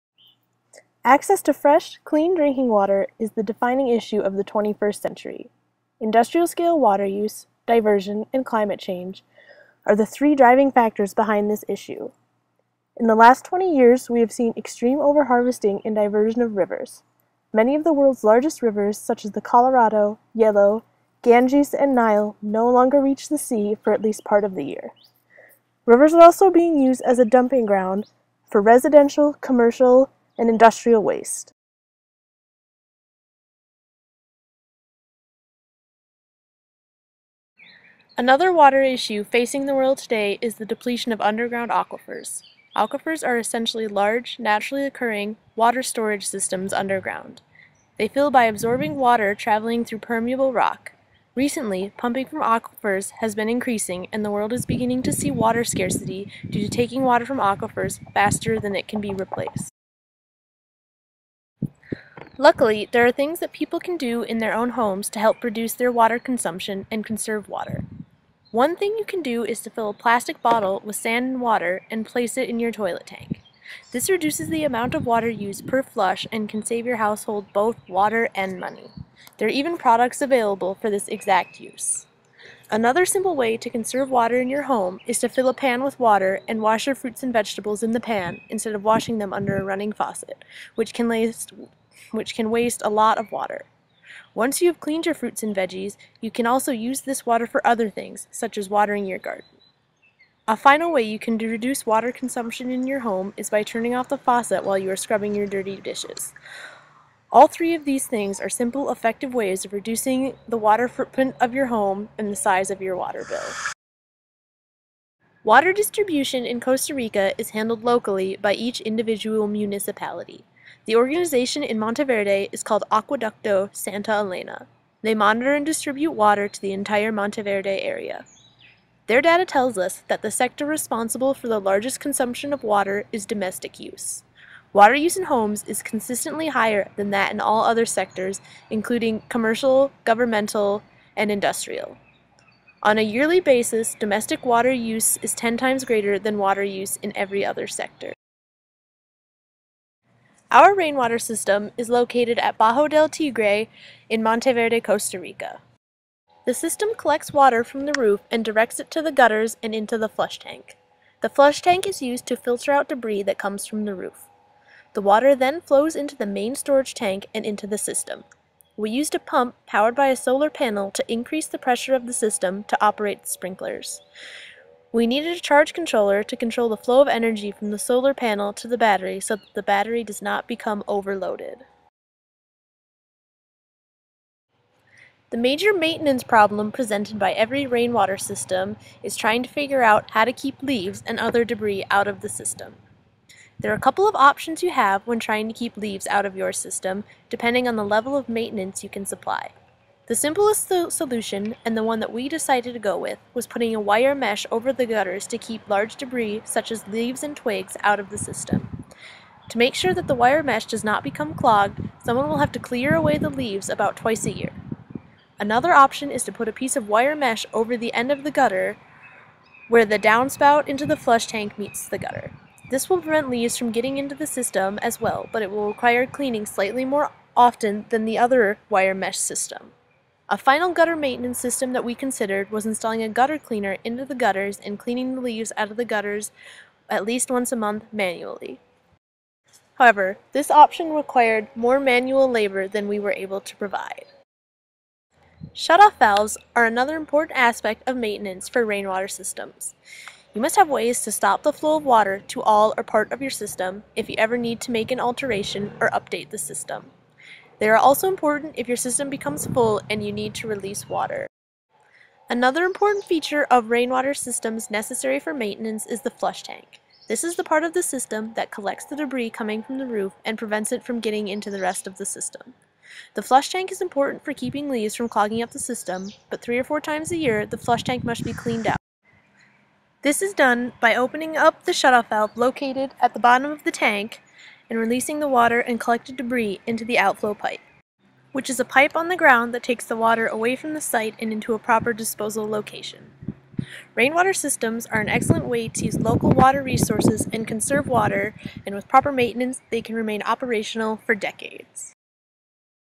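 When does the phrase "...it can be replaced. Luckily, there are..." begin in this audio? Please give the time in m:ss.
0:58.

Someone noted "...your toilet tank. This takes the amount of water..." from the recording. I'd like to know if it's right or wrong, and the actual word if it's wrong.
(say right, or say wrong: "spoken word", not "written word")
wrong: "reduces", not "takes".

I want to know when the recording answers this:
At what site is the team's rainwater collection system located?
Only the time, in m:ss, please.
2:32.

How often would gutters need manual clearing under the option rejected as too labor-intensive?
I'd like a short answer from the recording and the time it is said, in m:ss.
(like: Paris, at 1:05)
once a month, at 3:57.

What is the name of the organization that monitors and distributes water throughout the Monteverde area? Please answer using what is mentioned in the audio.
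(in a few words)
Acueducto Santa Elena.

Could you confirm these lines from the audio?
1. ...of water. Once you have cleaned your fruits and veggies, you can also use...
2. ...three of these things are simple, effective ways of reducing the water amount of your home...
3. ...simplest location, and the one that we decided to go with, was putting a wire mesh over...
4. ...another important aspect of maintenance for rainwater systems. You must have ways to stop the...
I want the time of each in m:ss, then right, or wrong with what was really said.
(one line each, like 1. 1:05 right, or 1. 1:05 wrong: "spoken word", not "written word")
1. 1:33 right
2. 1:47 wrong: "footprint", not "amount"
3. 3:20 wrong: "solution", not "location"
4. 4:06 right.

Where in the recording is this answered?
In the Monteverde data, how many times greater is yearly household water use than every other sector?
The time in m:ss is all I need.
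2:25.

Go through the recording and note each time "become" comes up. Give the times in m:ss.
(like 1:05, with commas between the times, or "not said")
3:00, 3:31, 4:19.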